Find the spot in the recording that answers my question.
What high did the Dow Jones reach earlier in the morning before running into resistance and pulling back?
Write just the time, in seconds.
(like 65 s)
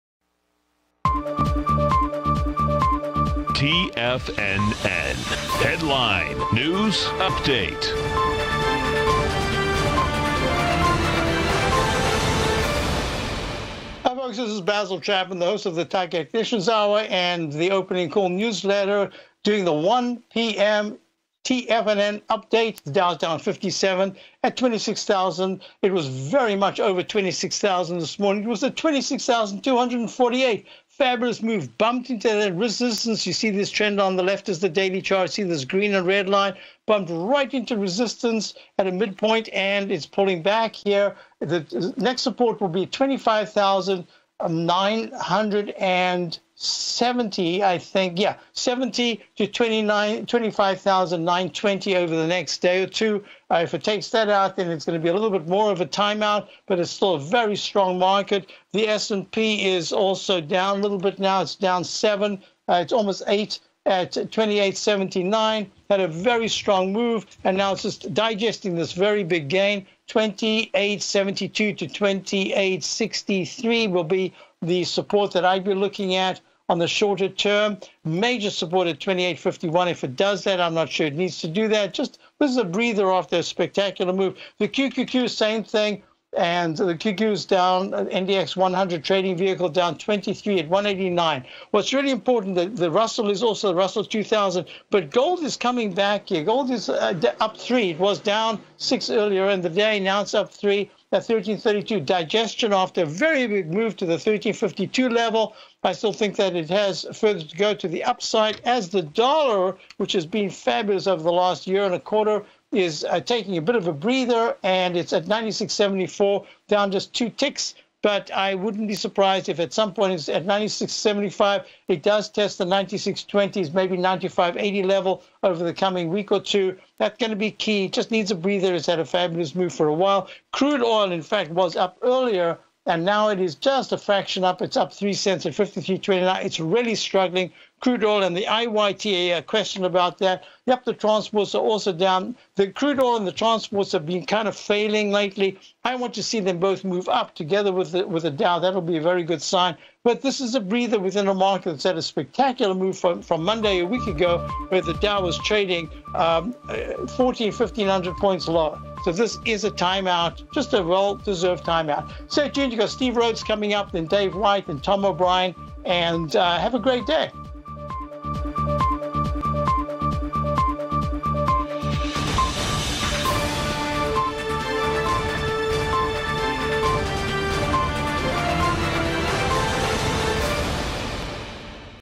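28 s.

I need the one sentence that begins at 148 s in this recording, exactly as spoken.
That'll be a very good sign.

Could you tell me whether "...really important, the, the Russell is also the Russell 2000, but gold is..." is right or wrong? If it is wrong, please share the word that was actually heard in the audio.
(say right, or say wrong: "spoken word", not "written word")
right.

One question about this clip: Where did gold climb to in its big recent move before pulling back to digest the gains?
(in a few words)
1352.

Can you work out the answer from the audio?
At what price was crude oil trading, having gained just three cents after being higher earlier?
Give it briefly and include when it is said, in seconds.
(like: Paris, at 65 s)
53.29, at 135 s.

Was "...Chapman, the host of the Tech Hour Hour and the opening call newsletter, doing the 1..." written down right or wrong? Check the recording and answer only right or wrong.
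wrong.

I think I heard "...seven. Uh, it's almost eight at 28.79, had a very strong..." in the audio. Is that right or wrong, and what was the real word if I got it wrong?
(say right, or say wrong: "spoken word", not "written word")
right.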